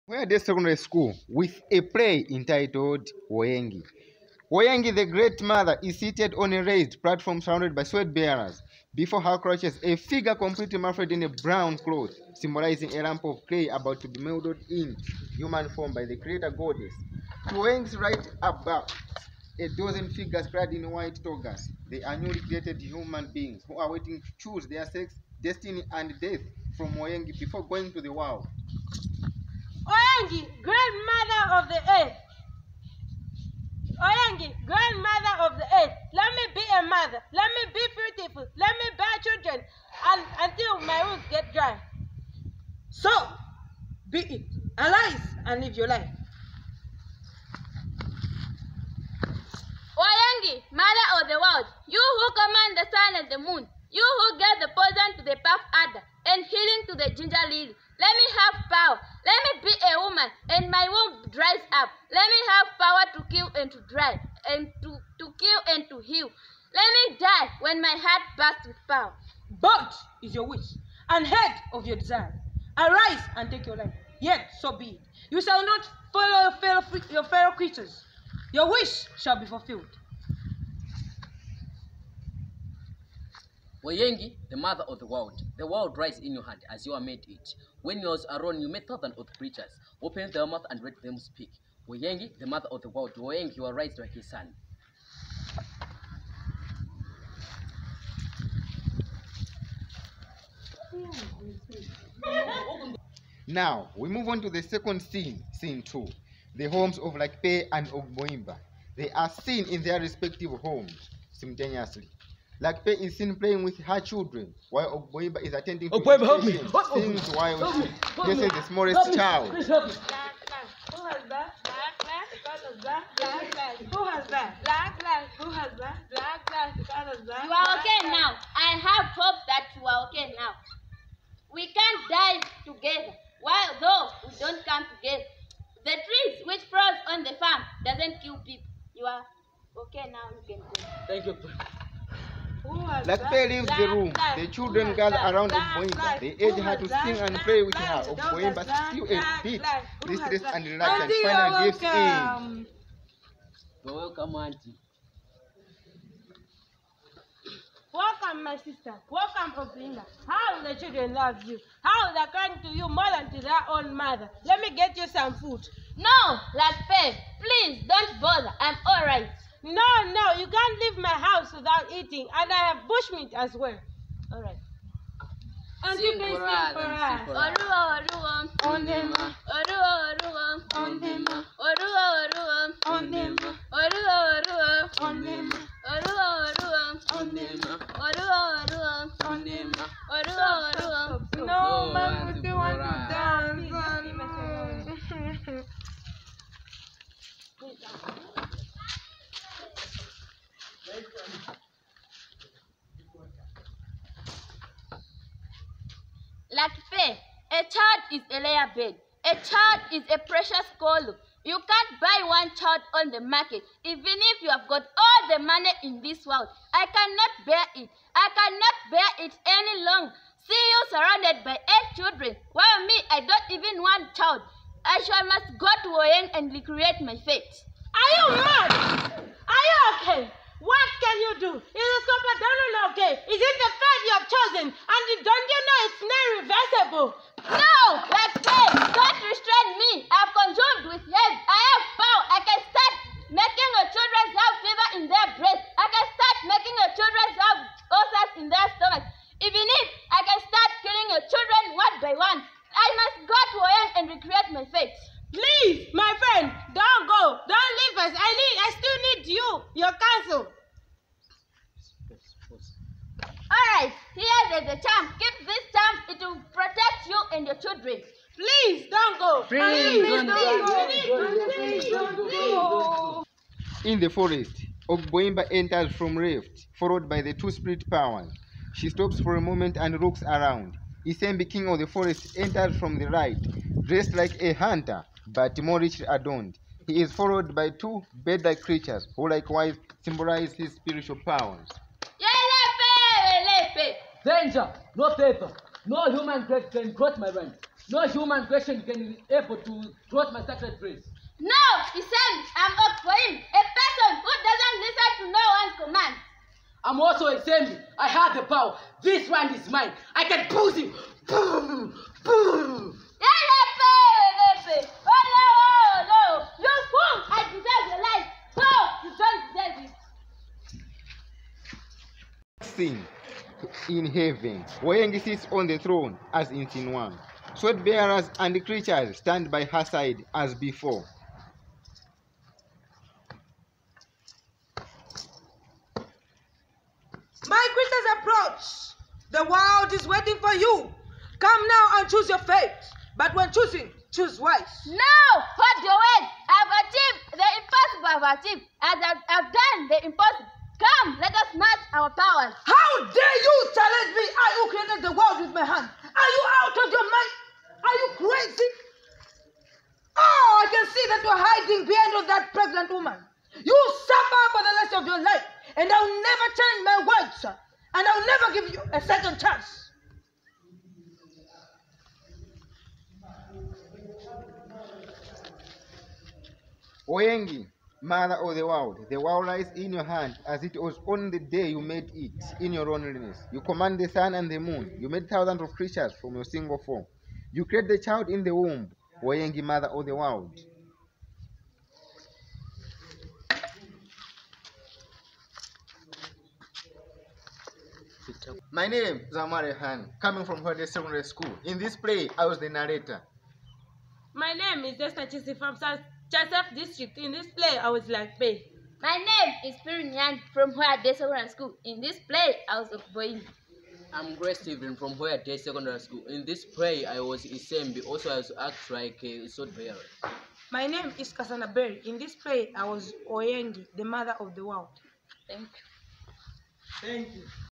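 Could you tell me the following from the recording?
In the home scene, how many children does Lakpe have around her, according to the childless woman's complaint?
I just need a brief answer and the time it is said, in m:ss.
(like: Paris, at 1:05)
8, at 3:41.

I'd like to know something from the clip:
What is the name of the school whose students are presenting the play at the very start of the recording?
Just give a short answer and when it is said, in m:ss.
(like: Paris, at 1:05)
Wayade Secondary School, at 0:00.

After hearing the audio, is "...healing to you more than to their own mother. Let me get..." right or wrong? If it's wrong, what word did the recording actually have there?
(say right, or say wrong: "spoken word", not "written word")
wrong: "crying", not "healing".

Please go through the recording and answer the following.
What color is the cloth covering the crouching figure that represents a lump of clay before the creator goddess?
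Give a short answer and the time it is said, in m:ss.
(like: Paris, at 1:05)
Brown, at 0:11.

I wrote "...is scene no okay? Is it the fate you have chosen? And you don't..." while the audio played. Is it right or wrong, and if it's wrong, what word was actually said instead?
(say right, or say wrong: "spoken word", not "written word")
wrong: "compadone", not "scene".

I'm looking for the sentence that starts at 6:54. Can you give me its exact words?
I'm Grace Stephen from where I did secondary school.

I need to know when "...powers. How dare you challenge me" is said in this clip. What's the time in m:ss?
5:52.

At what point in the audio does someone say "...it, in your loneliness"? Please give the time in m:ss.
6:22.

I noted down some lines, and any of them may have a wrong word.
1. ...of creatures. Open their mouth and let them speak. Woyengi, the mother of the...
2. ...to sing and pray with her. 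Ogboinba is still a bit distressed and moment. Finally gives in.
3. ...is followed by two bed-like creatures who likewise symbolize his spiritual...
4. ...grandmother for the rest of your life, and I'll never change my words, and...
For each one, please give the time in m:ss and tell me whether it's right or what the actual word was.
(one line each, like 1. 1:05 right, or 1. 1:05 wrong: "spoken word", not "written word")
1. 1:29 right
2. 2:26 wrong: "reluctant", not "moment"
3. 4:47 right
4. 6:04 wrong: "suffer", not "grandmother".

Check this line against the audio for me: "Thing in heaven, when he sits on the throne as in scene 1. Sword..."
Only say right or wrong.
right.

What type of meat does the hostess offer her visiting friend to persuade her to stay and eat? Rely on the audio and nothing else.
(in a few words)
Bushmeat.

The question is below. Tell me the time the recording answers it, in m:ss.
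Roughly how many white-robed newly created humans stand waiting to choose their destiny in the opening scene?
0:19.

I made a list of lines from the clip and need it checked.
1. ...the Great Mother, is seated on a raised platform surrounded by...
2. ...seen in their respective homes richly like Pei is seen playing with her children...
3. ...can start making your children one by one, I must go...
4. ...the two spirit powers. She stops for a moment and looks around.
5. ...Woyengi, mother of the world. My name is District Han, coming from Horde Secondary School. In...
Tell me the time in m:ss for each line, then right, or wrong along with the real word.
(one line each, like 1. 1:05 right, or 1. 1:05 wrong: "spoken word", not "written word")
1. 0:04 right
2. 1:49 wrong: "simultaneously", not "richly"
3. 4:10 wrong: "killing", not "making"
4. 4:37 right
5. 6:29 wrong: "Amare", not "District".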